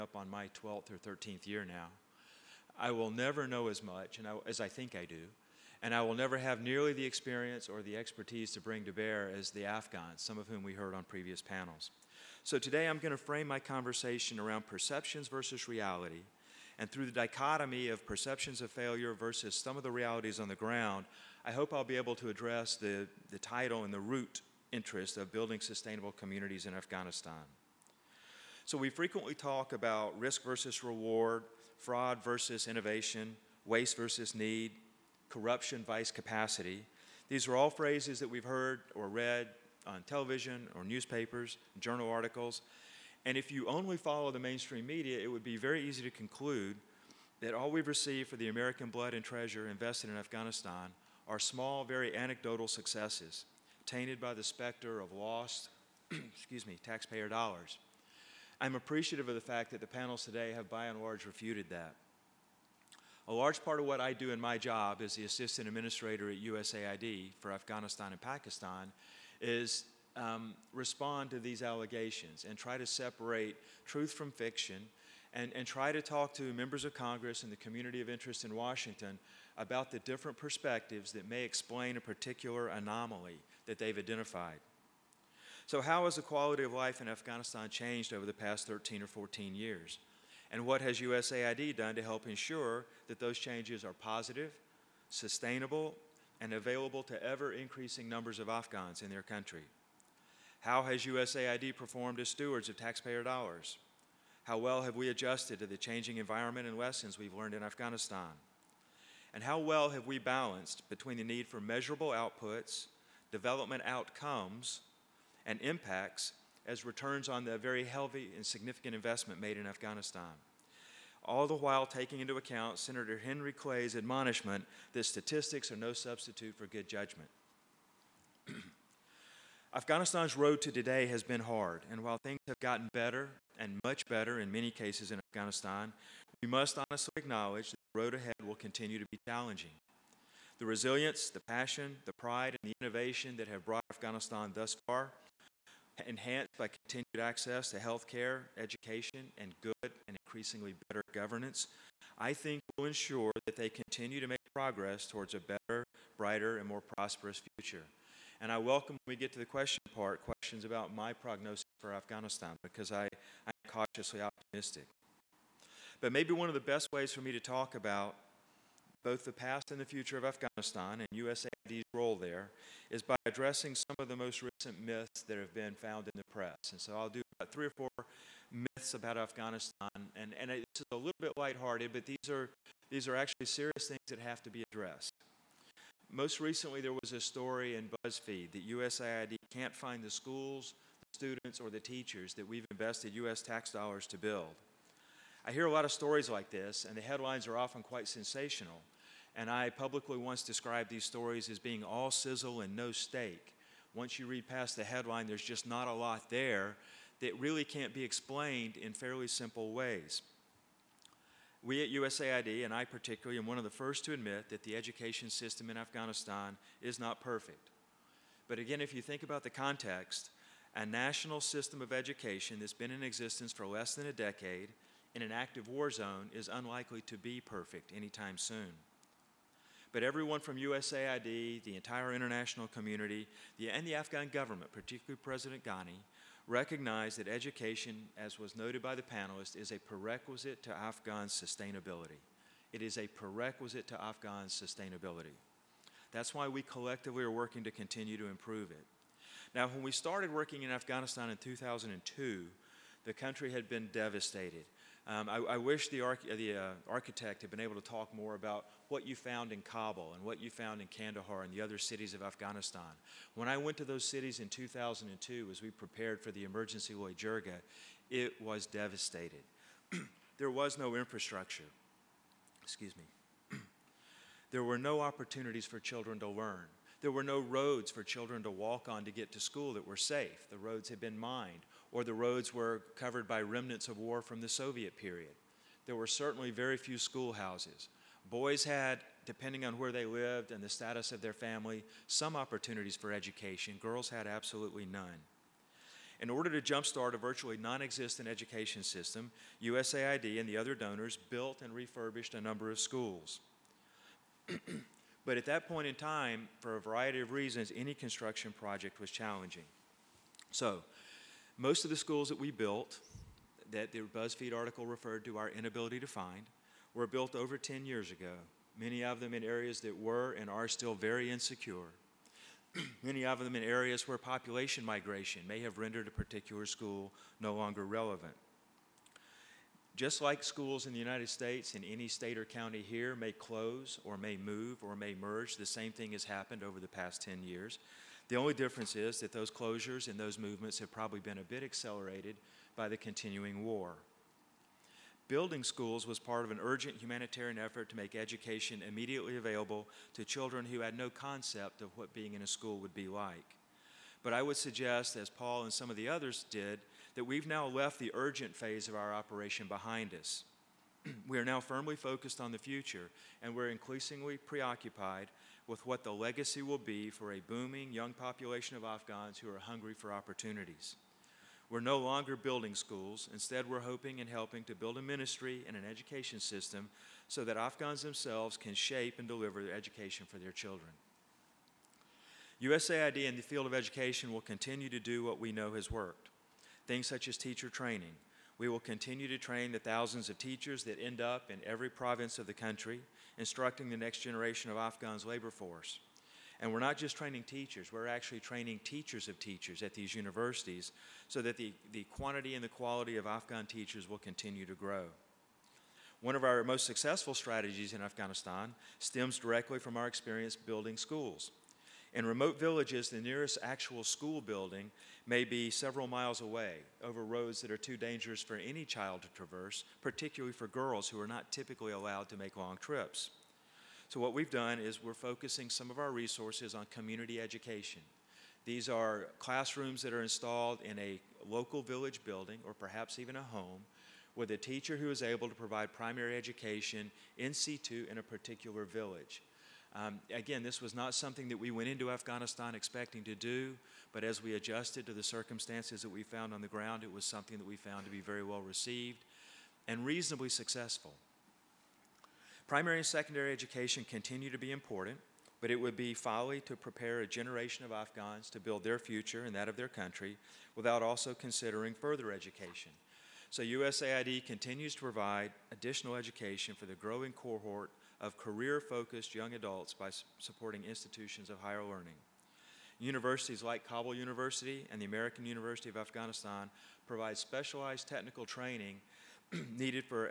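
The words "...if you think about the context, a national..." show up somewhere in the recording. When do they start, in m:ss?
3:38.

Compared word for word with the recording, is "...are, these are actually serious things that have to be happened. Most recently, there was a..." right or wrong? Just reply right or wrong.
wrong.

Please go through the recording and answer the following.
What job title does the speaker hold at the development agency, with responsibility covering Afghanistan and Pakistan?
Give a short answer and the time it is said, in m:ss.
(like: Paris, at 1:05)
Assistant administrator, at 1:05.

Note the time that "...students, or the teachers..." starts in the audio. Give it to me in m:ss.
3:11.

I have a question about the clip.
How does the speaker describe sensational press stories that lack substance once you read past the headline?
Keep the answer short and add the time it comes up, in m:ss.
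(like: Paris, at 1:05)
All sizzle and no steak, at 3:21.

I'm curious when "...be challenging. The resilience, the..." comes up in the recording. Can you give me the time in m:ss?
2:19.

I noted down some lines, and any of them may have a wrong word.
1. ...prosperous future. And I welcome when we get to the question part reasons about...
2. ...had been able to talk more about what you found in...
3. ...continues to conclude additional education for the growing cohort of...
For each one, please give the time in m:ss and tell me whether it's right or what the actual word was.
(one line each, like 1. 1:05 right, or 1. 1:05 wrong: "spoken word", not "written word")
1. 2:36 wrong: "questions", not "reasons"
2. 4:17 right
3. 7:44 wrong: "provide", not "conclude".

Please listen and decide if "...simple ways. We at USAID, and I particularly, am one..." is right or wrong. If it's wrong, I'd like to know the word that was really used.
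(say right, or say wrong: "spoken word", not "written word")
right.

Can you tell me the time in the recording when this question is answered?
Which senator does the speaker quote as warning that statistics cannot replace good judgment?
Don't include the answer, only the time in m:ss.
2:03.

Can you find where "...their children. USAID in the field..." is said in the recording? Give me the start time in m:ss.
6:20.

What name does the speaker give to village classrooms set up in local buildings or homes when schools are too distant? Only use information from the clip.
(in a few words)
Community education.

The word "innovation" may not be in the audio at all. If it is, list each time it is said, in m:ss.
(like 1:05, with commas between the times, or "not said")
0:32, 2:22.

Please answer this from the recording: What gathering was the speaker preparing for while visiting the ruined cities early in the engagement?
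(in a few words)
The emergency Jirga.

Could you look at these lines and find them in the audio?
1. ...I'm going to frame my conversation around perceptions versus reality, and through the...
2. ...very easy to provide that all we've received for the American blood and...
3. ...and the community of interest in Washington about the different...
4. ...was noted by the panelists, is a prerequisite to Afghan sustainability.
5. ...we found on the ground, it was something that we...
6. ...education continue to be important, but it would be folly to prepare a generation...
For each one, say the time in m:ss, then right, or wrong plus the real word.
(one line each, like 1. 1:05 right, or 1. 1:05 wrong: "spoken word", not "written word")
1. 0:12 right
2. 0:45 wrong: "conclude", not "provide"
3. 1:17 right
4. 3:58 right
5. 7:26 right
6. 7:33 right.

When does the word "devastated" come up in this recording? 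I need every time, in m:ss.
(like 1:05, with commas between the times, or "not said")
4:13, 4:28.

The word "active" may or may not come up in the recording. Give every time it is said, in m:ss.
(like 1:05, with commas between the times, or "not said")
3:45.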